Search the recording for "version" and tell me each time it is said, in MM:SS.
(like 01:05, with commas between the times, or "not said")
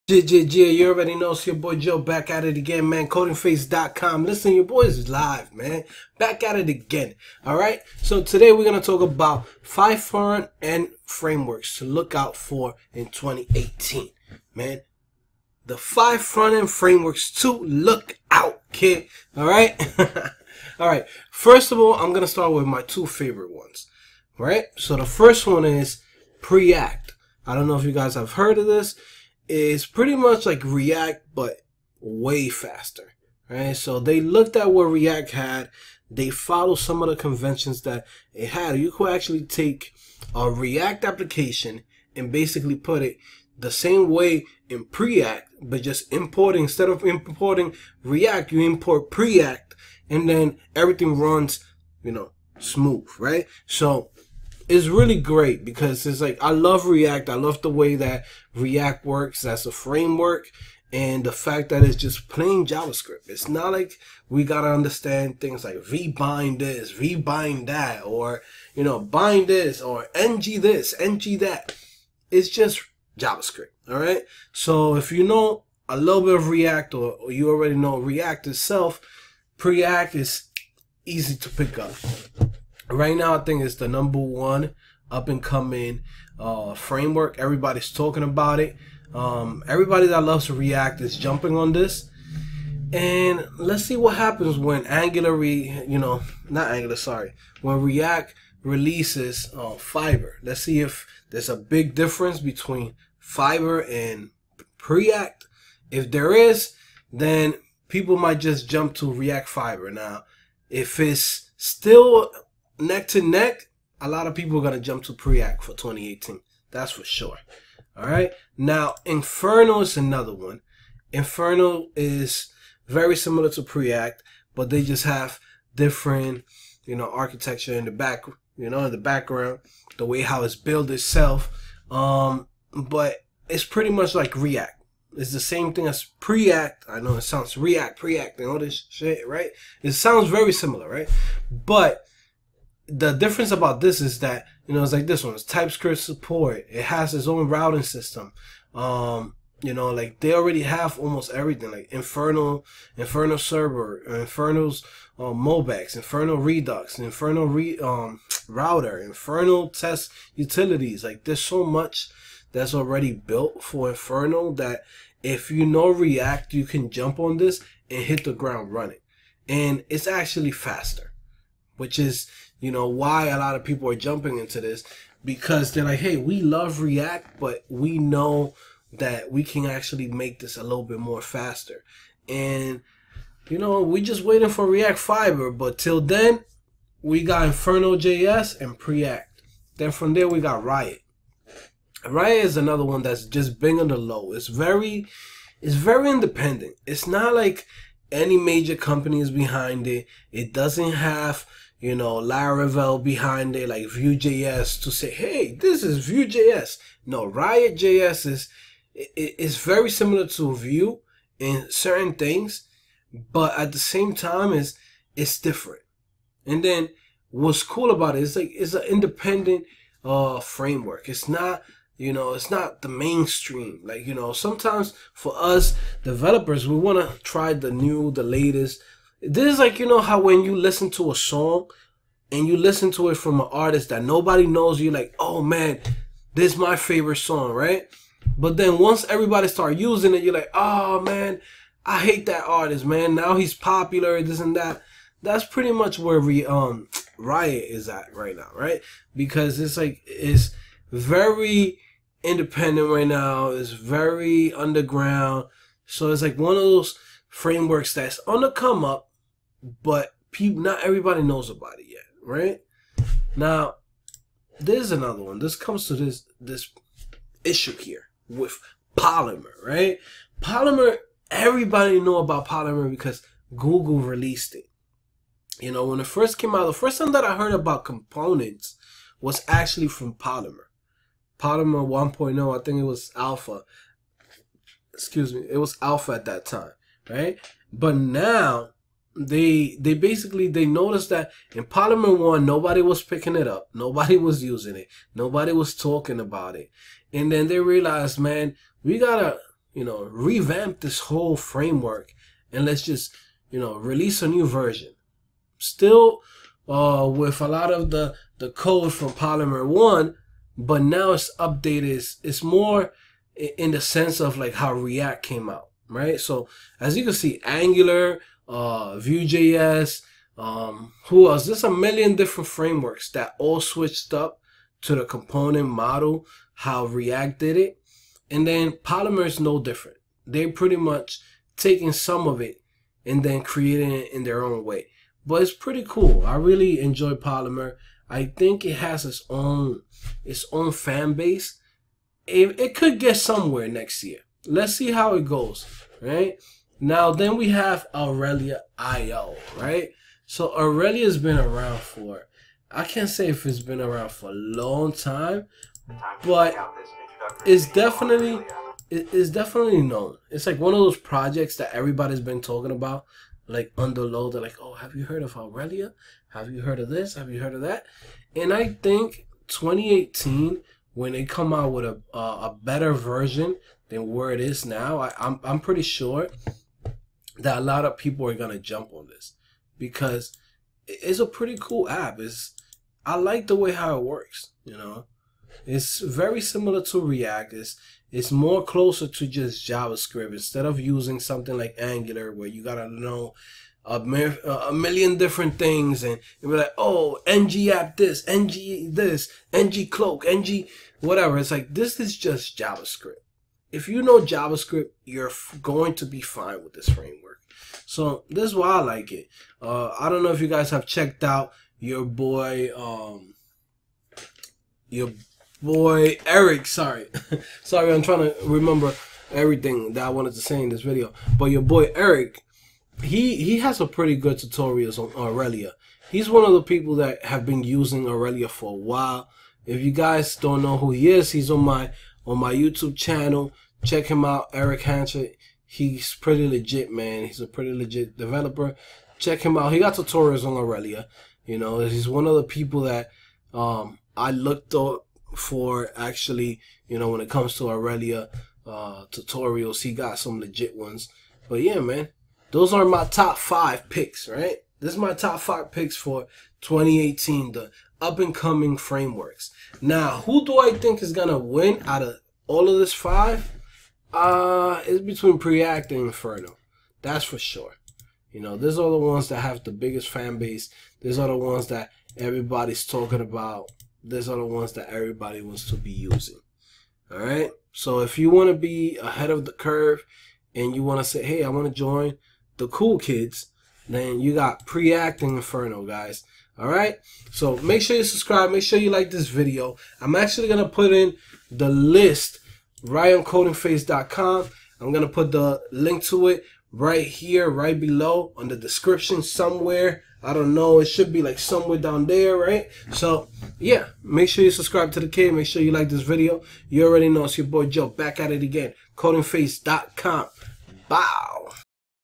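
05:04, 06:12.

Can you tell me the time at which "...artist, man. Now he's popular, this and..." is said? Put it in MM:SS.
04:02.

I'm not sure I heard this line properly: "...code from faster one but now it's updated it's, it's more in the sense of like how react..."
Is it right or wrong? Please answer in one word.
wrong.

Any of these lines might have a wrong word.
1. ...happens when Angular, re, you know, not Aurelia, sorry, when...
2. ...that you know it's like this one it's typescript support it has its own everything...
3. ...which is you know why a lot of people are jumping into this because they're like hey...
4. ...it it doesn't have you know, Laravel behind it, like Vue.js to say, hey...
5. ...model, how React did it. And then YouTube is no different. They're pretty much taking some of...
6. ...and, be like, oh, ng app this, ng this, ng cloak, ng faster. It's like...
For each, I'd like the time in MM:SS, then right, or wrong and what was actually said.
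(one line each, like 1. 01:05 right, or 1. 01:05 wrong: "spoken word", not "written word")
1. 01:34 wrong: "Angular", not "Aurelia"
2. 02:24 wrong: "routing", not "everything"
3. 02:51 right
4. 03:19 right
5. 05:25 wrong: "Polymer", not "YouTube"
6. 06:36 wrong: "whatever", not "faster".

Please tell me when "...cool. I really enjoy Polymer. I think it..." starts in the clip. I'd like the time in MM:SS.
05:35.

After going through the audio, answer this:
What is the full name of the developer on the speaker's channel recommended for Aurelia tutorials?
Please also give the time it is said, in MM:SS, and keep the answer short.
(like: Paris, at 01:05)
Eric Hanchett, at 07:14.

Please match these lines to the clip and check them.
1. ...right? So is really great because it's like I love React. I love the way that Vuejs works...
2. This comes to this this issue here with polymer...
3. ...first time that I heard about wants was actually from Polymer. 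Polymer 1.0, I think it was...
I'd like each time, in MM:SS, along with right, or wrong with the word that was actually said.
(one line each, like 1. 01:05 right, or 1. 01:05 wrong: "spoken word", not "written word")
1. 00:53 wrong: "React", not "Vuejs"
2. 04:25 right
3. 04:36 wrong: "components", not "wants".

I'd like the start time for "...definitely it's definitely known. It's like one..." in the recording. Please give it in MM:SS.
05:57.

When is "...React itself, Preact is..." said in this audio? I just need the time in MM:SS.
01:17.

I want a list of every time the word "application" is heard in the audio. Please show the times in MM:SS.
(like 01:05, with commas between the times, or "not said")
00:41.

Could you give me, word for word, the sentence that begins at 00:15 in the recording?
The five front end frameworks to look out, kid.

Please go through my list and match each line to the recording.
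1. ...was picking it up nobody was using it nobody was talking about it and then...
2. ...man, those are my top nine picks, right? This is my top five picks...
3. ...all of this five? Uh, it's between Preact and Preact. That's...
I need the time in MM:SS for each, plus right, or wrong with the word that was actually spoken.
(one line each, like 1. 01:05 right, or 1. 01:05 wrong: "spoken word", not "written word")
1. 04:52 right
2. 07:31 wrong: "five", not "nine"
3. 07:42 wrong: "Inferno", not "Preact".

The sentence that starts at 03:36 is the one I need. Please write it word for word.
And then what's cool about it is like, it's an independent, uh, framework.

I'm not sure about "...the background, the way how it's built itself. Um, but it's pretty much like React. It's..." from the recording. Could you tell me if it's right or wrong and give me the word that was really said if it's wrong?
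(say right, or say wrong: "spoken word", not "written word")
right.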